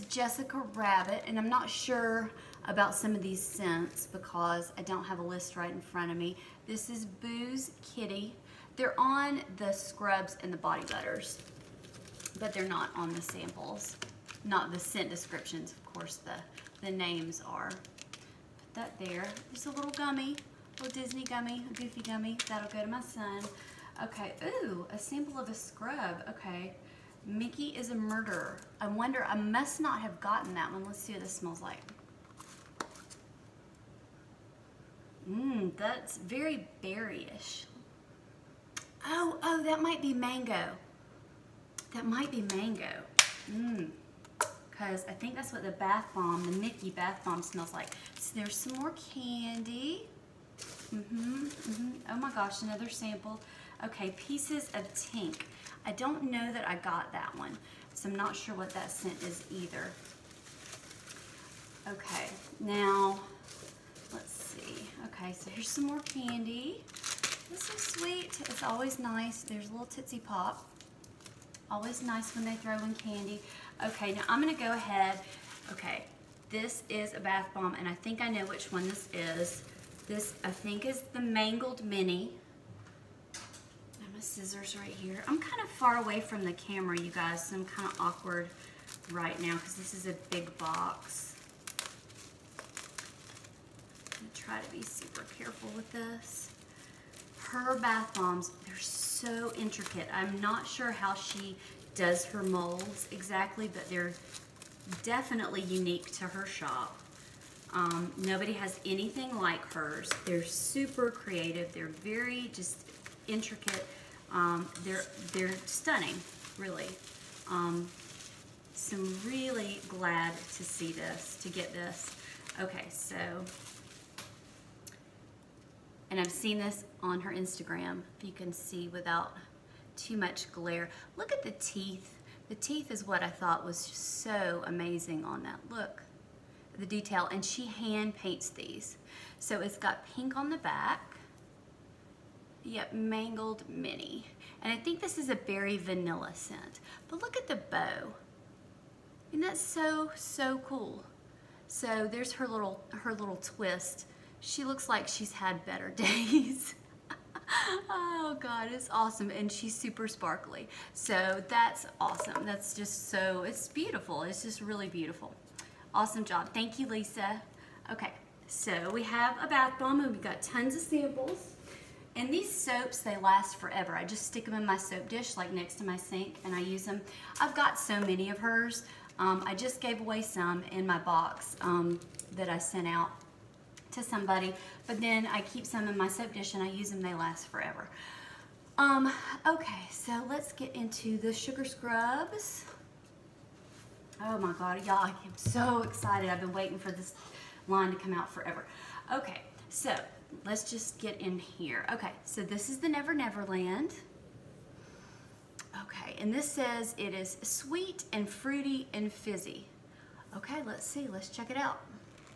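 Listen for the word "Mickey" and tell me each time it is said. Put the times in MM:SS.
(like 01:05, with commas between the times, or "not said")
00:27, 00:46.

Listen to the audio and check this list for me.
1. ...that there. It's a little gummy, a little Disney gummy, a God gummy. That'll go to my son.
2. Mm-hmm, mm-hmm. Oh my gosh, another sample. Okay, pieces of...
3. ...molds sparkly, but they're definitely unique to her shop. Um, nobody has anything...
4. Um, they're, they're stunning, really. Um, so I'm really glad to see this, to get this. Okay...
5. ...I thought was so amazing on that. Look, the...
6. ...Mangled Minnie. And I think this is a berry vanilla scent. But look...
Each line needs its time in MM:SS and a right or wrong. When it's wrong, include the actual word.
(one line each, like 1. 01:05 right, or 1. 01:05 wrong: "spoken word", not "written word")
1. 00:18 wrong: "Goofy", not "God"
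2. 00:50 right
3. 01:42 wrong: "exactly", not "sparkly"
4. 01:54 right
5. 02:13 right
6. 02:22 right.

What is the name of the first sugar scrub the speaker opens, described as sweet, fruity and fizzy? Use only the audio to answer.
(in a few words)
Never Never Land.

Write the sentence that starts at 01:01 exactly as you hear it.
Okay, now Okay, so here's some more candy.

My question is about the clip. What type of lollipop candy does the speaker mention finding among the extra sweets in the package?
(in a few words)
Tootsie Pop.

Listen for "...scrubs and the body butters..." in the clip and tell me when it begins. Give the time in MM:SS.
00:09.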